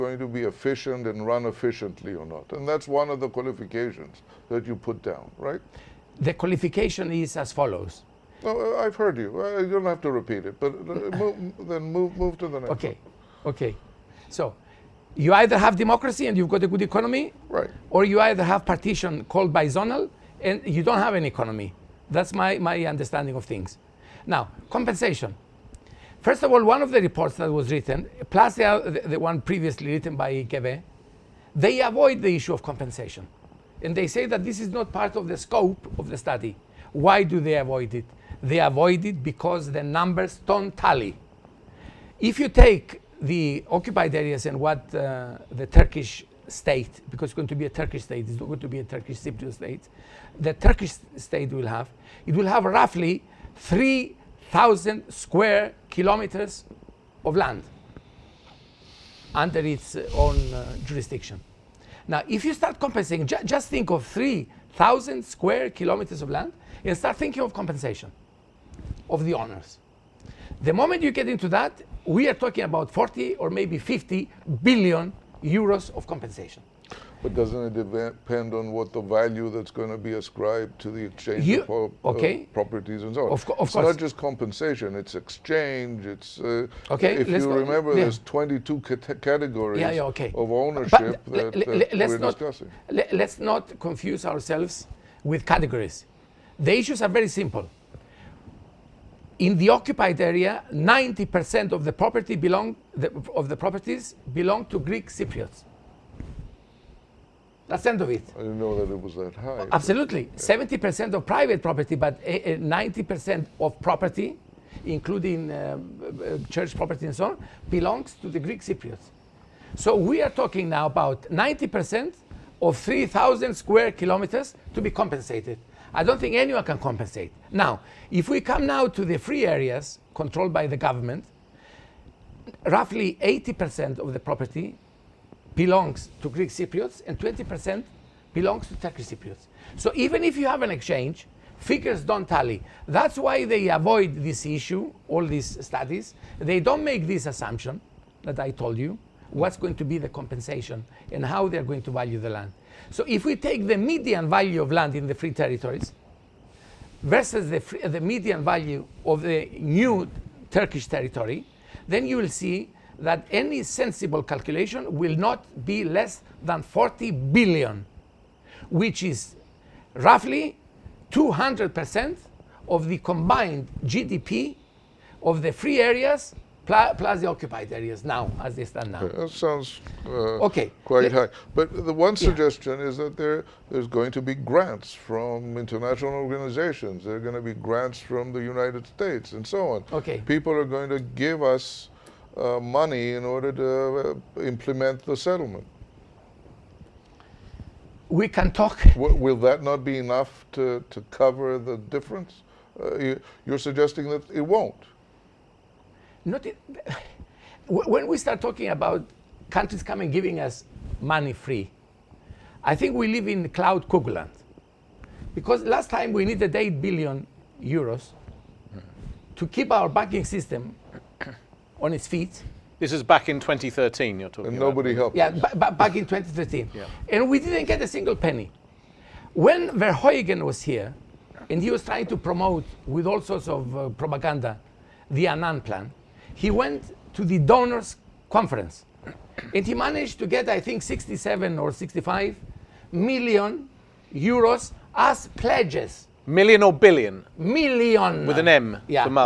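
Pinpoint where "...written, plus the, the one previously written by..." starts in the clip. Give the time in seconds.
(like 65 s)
27 s.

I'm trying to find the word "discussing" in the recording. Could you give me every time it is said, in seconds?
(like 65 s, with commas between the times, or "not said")
92 s.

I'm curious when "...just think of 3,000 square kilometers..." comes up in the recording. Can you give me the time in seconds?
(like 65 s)
63 s.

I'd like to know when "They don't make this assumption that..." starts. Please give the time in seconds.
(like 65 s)
146 s.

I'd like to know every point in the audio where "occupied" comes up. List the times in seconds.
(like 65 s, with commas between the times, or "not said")
43 s, 99 s, 177 s.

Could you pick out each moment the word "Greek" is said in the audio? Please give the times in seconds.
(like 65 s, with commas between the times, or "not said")
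104 s, 118 s, 136 s.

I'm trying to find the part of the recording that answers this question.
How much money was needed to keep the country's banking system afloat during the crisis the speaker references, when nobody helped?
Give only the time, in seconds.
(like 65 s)
216 s.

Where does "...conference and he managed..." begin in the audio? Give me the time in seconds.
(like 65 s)
238 s.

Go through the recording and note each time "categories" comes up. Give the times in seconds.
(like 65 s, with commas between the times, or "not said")
89 s, 95 s.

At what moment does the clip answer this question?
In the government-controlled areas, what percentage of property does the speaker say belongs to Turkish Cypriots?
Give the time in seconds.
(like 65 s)
137 s.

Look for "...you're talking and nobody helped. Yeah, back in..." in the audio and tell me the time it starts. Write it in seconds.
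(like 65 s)
224 s.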